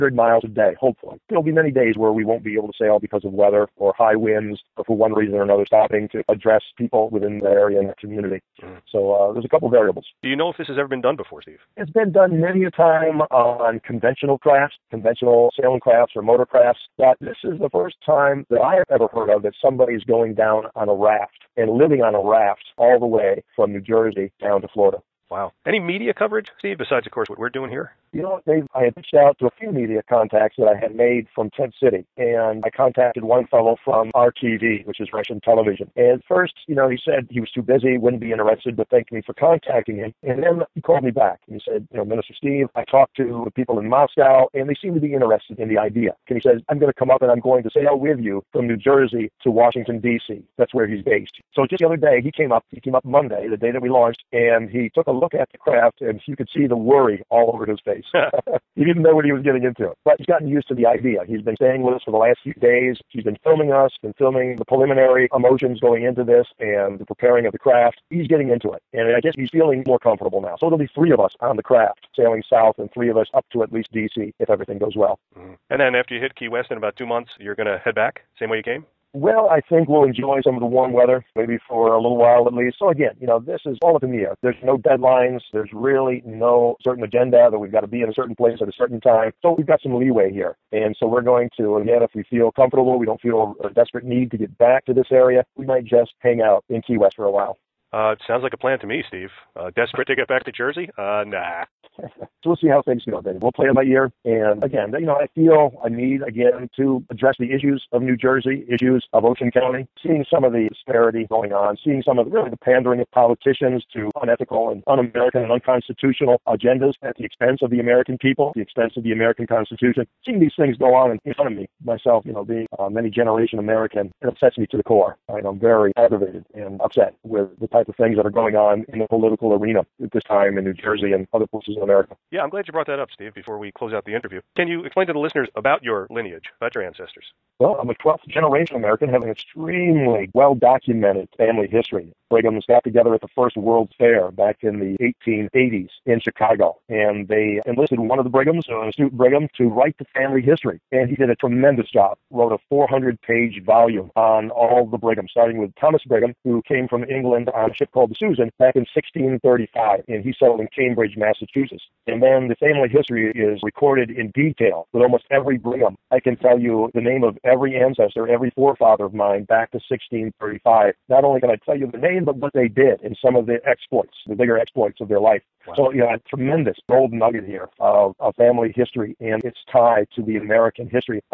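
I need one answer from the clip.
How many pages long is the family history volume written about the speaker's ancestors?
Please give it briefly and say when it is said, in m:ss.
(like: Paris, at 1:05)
400, at 2:32.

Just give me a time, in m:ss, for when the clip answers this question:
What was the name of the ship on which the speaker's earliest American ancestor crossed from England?
2:38.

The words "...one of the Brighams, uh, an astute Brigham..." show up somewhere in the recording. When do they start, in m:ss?
2:27.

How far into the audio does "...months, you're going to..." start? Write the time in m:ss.
1:17.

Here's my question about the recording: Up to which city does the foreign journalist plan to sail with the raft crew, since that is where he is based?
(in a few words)
Washington, D.C.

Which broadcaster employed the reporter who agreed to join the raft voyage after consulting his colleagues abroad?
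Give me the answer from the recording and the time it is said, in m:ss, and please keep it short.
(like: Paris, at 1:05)
RTV, at 0:34.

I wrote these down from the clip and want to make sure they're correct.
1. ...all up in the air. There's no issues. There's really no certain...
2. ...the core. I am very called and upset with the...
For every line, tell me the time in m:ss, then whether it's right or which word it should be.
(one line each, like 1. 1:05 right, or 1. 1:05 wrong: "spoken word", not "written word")
1. 1:23 wrong: "deadlines", not "issues"
2. 2:04 wrong: "aggravated", not "called".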